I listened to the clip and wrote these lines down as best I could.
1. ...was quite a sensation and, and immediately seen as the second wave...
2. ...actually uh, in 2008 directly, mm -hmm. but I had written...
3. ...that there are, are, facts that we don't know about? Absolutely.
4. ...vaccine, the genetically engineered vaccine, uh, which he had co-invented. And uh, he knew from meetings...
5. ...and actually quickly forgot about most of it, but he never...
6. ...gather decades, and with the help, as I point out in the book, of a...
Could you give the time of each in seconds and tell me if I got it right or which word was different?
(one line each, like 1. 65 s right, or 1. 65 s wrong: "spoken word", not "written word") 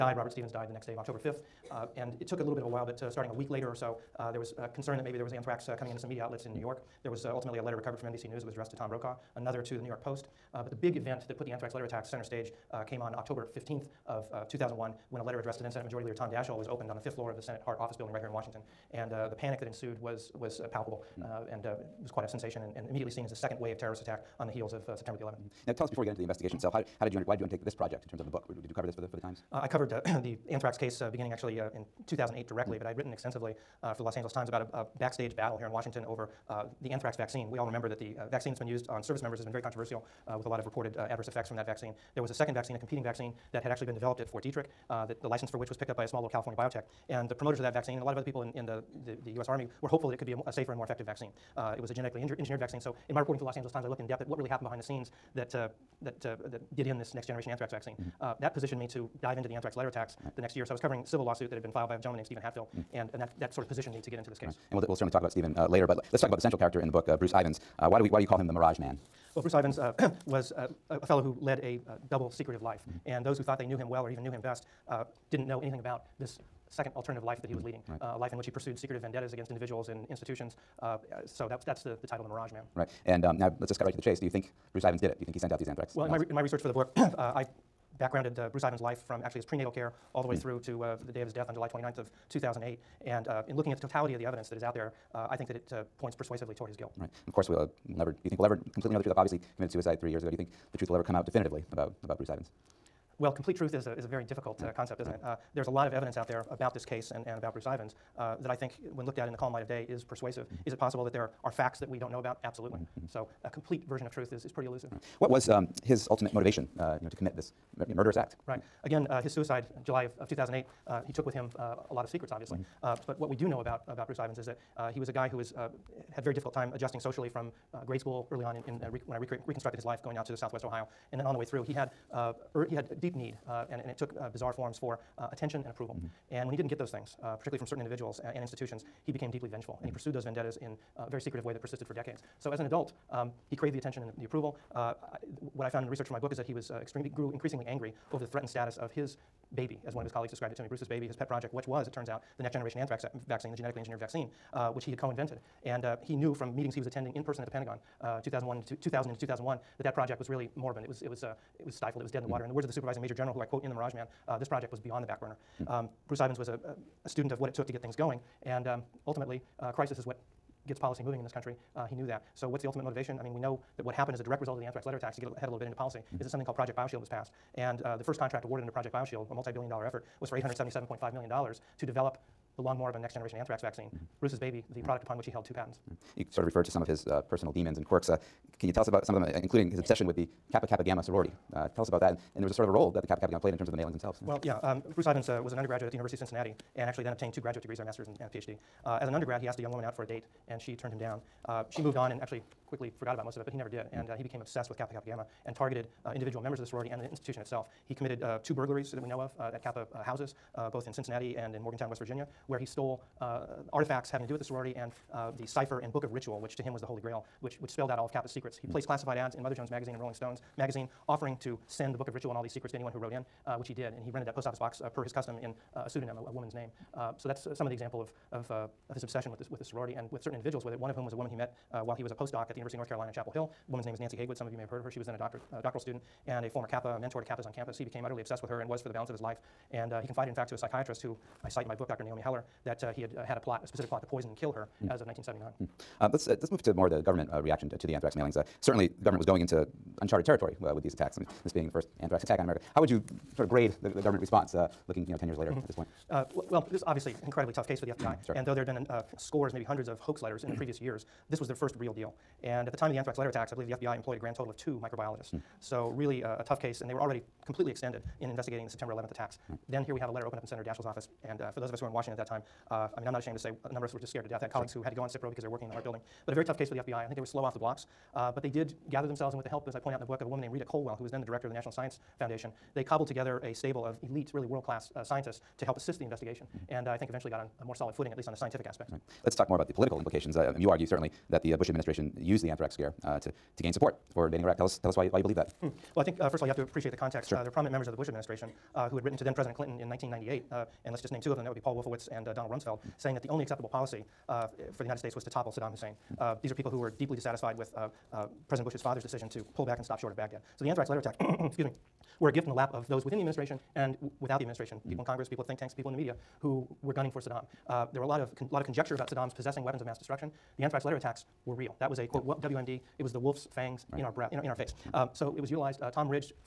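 1. 22 s right
2. 31 s right
3. 111 s right
4. 153 s right
5. 202 s right
6. 278 s wrong: "themselves", not "decades".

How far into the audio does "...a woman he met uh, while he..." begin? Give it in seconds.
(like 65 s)
231 s.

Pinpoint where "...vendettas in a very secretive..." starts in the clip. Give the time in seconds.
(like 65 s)
140 s.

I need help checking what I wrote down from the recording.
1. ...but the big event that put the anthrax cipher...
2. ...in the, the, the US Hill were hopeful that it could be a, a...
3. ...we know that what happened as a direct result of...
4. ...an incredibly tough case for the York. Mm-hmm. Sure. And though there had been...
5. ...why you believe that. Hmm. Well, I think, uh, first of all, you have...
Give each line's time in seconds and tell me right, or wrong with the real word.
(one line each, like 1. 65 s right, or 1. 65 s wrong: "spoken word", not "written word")
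1. 10 s wrong: "letter", not "cipher"
2. 48 s wrong: "Army", not "Hill"
3. 173 s right
4. 257 s wrong: "FBI", not "York"
5. 295 s right.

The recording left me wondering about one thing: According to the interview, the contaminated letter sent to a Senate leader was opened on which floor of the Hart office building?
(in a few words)
5th floor.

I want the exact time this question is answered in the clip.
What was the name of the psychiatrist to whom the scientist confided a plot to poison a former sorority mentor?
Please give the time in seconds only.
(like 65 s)
242 s.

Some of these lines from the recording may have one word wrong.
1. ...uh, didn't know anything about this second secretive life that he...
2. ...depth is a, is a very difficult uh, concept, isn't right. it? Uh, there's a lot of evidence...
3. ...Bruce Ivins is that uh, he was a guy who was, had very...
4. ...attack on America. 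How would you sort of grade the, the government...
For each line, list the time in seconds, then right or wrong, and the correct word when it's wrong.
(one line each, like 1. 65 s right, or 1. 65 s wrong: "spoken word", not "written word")
1. 74 s wrong: "alternative", not "secretive"
2. 103 s wrong: "truth", not "depth"
3. 124 s right
4. 252 s right.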